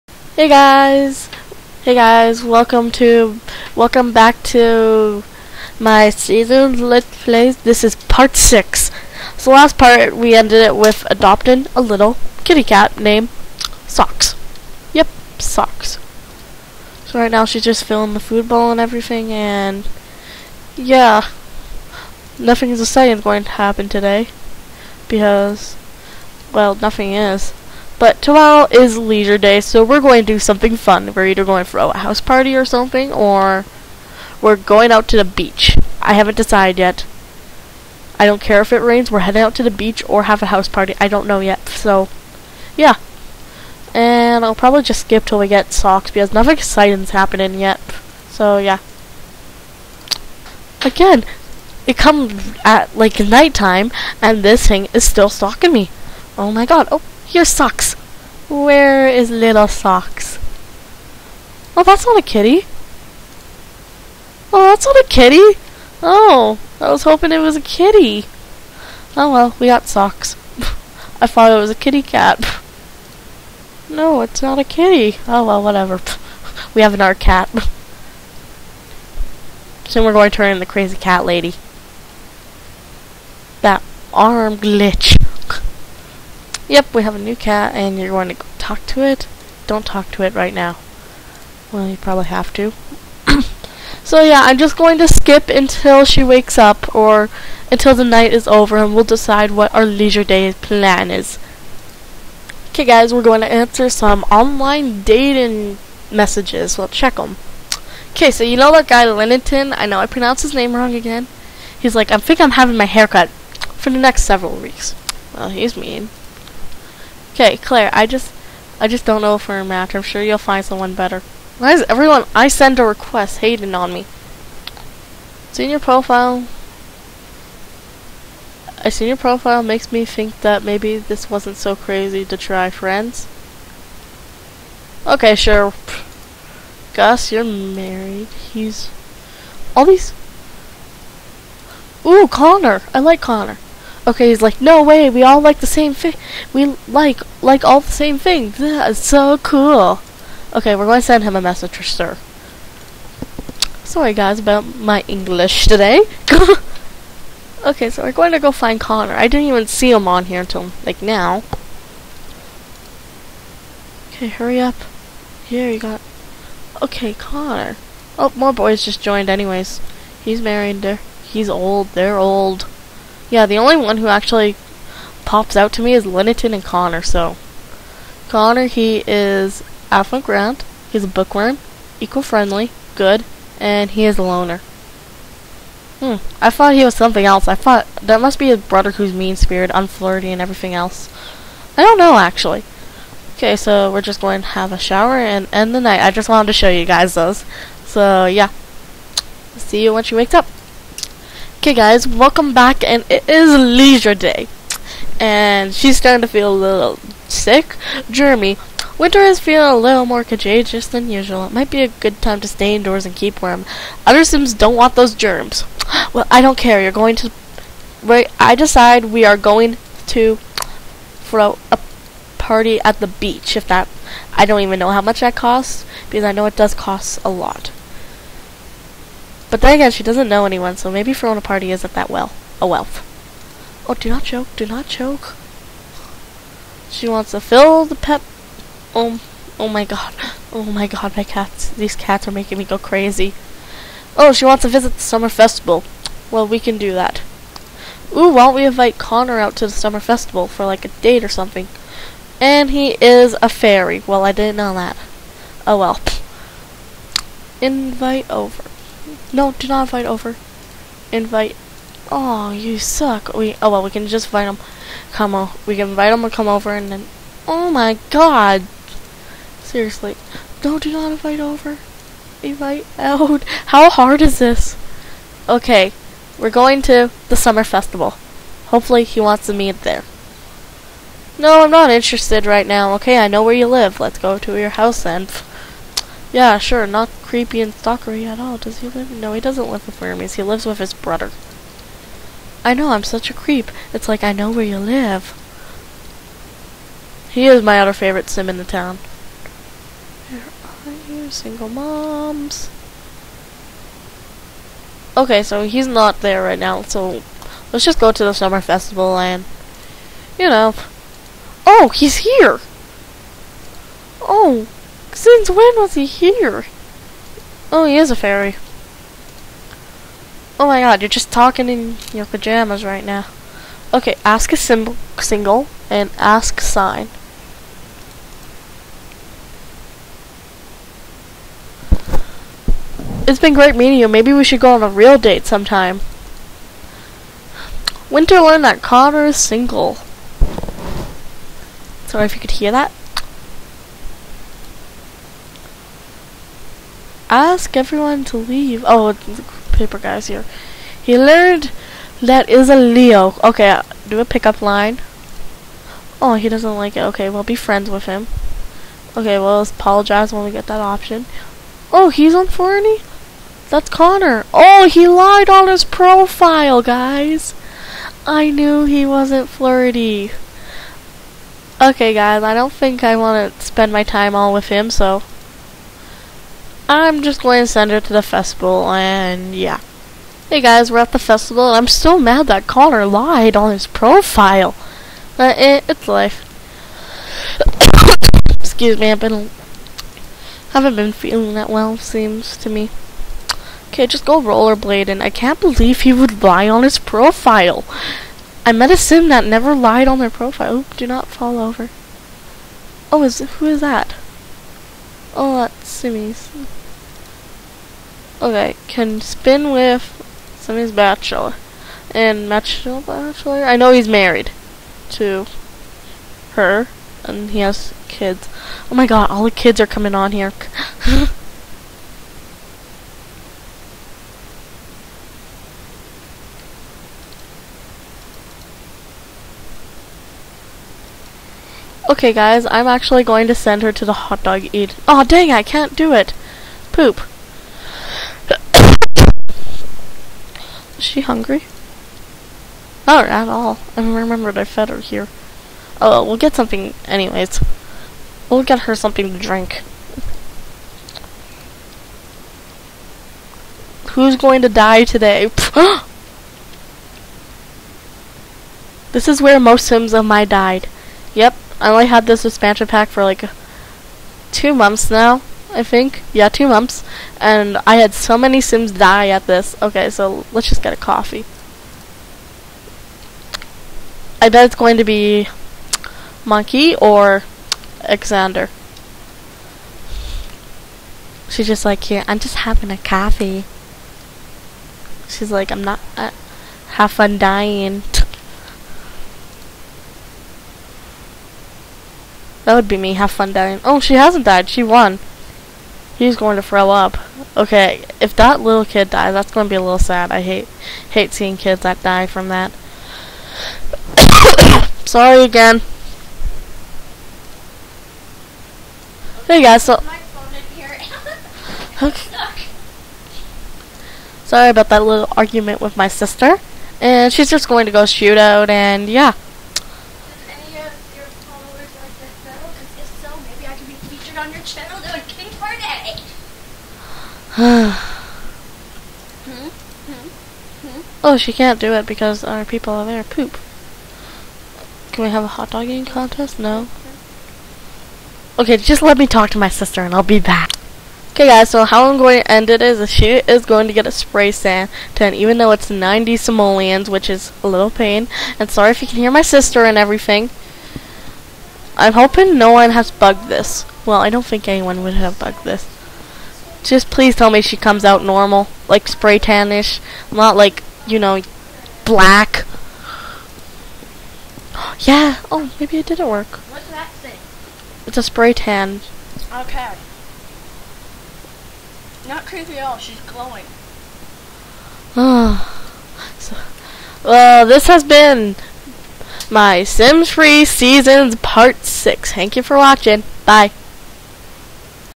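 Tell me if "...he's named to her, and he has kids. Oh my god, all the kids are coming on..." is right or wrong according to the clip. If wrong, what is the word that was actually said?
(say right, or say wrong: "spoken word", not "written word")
wrong: "married", not "named".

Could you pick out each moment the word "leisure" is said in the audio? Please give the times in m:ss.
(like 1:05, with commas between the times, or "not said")
0:28, 1:39, 3:23.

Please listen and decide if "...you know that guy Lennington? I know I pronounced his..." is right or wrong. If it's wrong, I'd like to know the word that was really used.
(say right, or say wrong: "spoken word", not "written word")
right.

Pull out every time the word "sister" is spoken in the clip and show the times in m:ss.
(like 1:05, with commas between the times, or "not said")
8:36, 8:59, 9:09.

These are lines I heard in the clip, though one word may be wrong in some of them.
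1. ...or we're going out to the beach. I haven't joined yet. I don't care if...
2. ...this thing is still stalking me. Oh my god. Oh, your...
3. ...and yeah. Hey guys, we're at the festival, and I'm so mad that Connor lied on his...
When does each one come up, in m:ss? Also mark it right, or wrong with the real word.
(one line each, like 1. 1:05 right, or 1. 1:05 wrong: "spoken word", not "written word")
1. 0:33 wrong: "decided", not "joined"
2. 0:54 right
3. 6:18 right.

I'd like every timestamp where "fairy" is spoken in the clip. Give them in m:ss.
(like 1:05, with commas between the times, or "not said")
4:13, 5:18.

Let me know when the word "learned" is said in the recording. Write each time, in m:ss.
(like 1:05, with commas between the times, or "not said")
5:38, 5:51.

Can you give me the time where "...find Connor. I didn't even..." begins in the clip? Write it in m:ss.
2:38.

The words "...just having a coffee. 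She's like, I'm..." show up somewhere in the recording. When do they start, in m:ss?
8:02.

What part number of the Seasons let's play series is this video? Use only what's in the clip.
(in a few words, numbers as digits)
6.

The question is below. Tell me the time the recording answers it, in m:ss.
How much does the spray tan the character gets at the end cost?
9:05.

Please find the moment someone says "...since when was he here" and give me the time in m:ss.
5:15.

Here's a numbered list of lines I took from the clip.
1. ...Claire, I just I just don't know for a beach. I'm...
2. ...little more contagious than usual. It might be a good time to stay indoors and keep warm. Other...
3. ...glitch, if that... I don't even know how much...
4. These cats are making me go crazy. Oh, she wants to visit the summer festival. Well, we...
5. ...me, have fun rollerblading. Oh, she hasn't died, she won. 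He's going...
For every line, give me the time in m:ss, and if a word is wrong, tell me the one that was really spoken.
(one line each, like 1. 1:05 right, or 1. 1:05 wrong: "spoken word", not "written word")
1. 1:57 wrong: "match", not "beach"
2. 3:29 right
3. 3:43 wrong: "beach", not "glitch"
4. 4:01 right
5. 8:12 wrong: "dying", not "rollerblading".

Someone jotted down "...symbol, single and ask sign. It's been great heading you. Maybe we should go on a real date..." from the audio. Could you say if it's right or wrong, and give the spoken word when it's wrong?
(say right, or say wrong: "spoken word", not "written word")
wrong: "meeting", not "heading".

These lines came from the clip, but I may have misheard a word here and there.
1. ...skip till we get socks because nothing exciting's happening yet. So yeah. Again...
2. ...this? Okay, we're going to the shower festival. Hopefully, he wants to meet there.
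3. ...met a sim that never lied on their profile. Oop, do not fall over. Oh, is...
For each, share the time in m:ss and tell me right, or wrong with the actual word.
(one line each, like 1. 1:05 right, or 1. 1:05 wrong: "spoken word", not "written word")
1. 0:45 right
2. 4:34 wrong: "summer", not "shower"
3. 6:38 right.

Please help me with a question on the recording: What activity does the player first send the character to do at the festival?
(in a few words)
rollerblading.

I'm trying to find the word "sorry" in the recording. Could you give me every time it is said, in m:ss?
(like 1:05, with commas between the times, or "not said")
2:33, 5:42, 8:25, 8:34, 9:08.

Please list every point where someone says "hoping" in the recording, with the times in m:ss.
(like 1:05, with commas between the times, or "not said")
1:07, 9:12.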